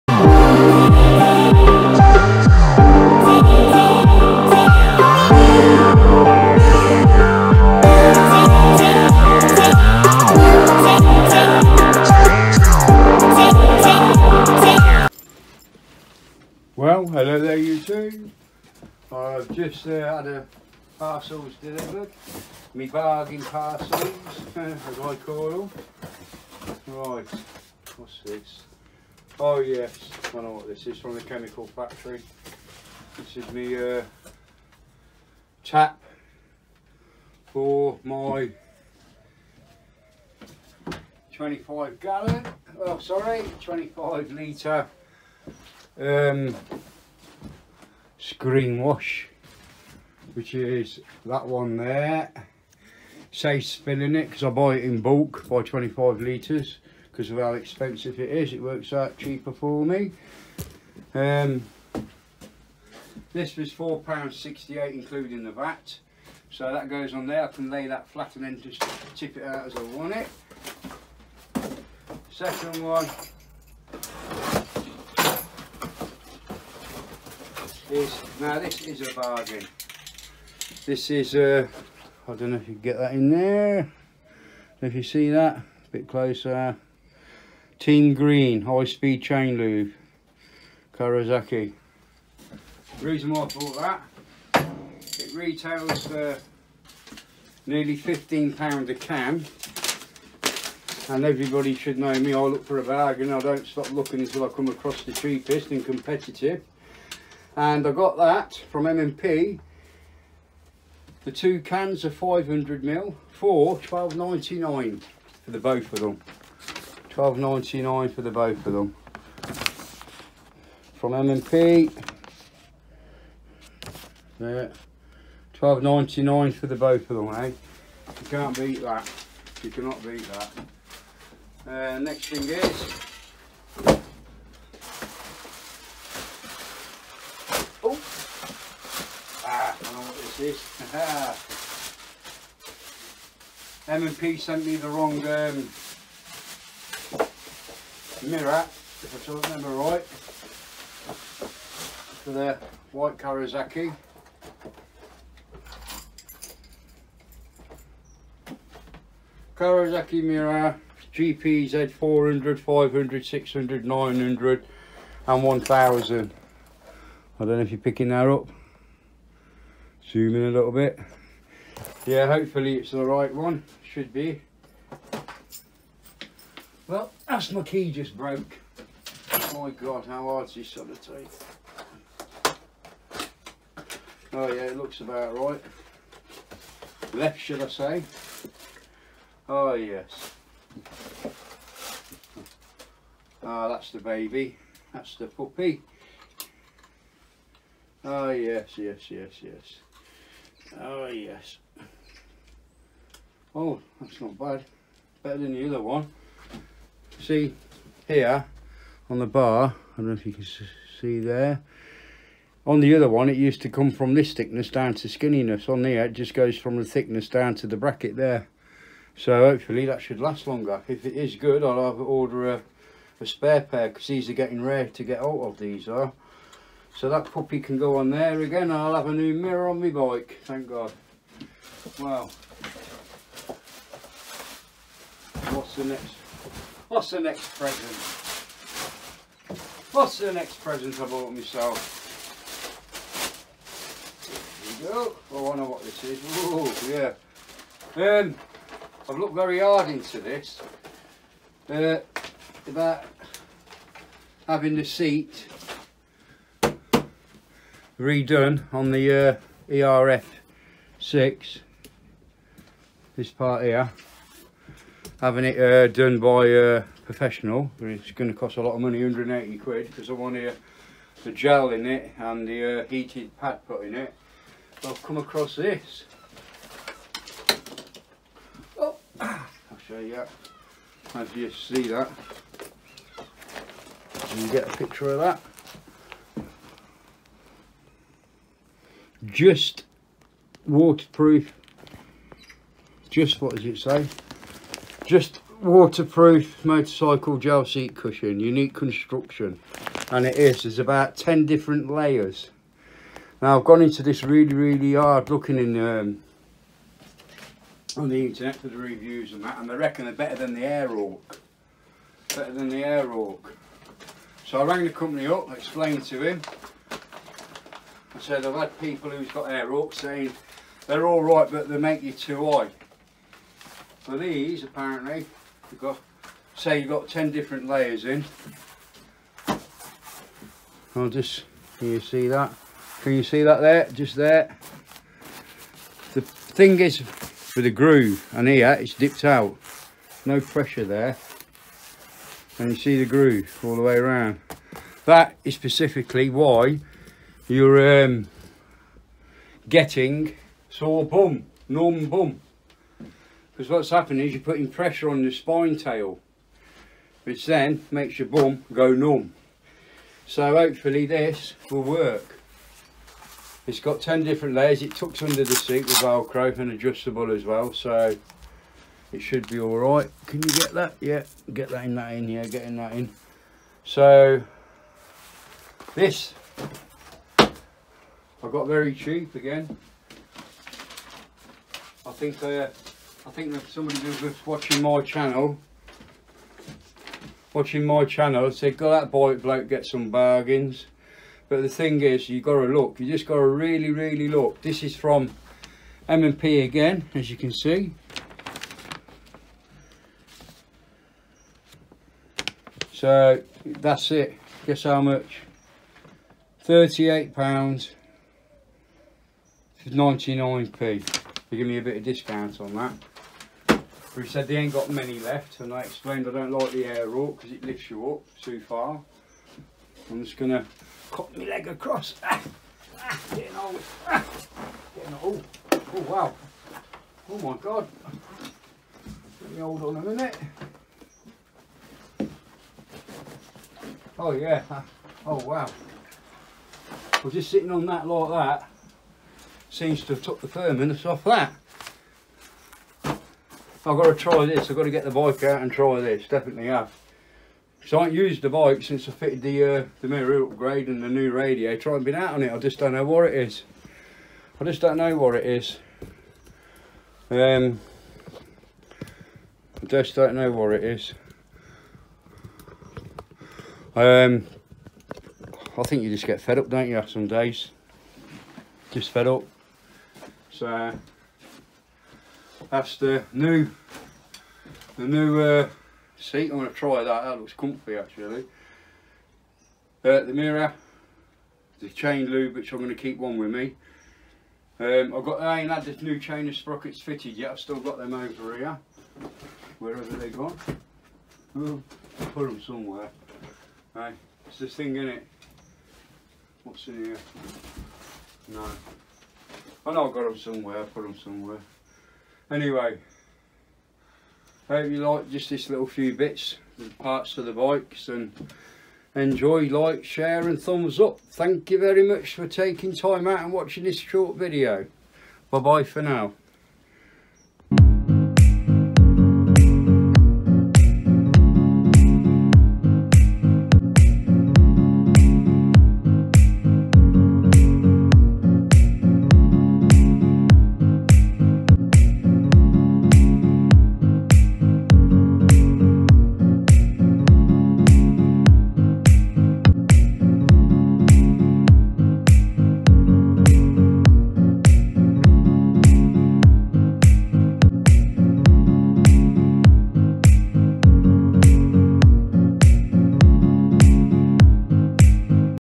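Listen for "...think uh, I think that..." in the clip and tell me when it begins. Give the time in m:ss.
6:22.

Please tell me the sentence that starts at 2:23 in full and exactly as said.
M&P sent me the wrong um, mirror, if I don't remember right, for the white Kawasaki.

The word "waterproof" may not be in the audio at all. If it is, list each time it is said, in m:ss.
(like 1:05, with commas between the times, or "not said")
4:50, 4:55.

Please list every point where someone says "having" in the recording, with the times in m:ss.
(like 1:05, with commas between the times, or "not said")
4:14, 4:25.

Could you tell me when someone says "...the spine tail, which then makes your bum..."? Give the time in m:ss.
5:55.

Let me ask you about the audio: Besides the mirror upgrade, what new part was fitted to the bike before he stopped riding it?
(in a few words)
radiator.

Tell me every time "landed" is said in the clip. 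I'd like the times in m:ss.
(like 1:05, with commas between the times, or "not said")
not said.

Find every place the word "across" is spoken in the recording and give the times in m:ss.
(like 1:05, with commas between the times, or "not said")
1:44, 4:35, 7:01.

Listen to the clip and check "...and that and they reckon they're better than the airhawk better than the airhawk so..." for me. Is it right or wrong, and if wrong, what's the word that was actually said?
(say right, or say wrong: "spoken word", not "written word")
right.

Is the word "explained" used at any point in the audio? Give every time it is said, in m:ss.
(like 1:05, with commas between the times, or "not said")
5:15, 6:55.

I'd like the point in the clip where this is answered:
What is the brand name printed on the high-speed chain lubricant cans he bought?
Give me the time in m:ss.
1:27.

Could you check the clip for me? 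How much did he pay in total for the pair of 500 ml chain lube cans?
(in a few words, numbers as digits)
12.99.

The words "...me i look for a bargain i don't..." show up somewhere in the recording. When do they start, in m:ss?
1:42.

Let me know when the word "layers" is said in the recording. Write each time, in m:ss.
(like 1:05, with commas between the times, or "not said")
5:01, 5:27, 6:04.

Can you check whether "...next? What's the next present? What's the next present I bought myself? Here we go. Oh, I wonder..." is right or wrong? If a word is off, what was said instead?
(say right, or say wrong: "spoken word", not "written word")
right.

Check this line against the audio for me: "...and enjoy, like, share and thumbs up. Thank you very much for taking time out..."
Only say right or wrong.
right.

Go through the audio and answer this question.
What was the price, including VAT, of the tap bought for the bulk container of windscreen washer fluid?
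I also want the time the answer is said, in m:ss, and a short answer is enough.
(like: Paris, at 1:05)
£4.68, at 1:03.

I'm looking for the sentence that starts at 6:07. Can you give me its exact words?
So it should be all right.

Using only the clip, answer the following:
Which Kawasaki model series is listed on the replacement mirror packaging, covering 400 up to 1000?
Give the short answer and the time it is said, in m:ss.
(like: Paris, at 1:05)
GPZ, at 2:41.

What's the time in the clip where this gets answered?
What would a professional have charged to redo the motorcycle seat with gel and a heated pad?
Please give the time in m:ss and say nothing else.
4:29.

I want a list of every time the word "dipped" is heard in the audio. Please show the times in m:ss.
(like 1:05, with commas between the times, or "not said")
5:38.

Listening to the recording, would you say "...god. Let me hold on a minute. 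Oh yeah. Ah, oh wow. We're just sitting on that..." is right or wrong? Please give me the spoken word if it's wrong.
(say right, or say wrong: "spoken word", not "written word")
right.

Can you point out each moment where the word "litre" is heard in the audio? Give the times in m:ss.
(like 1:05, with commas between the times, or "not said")
0:44, 0:56.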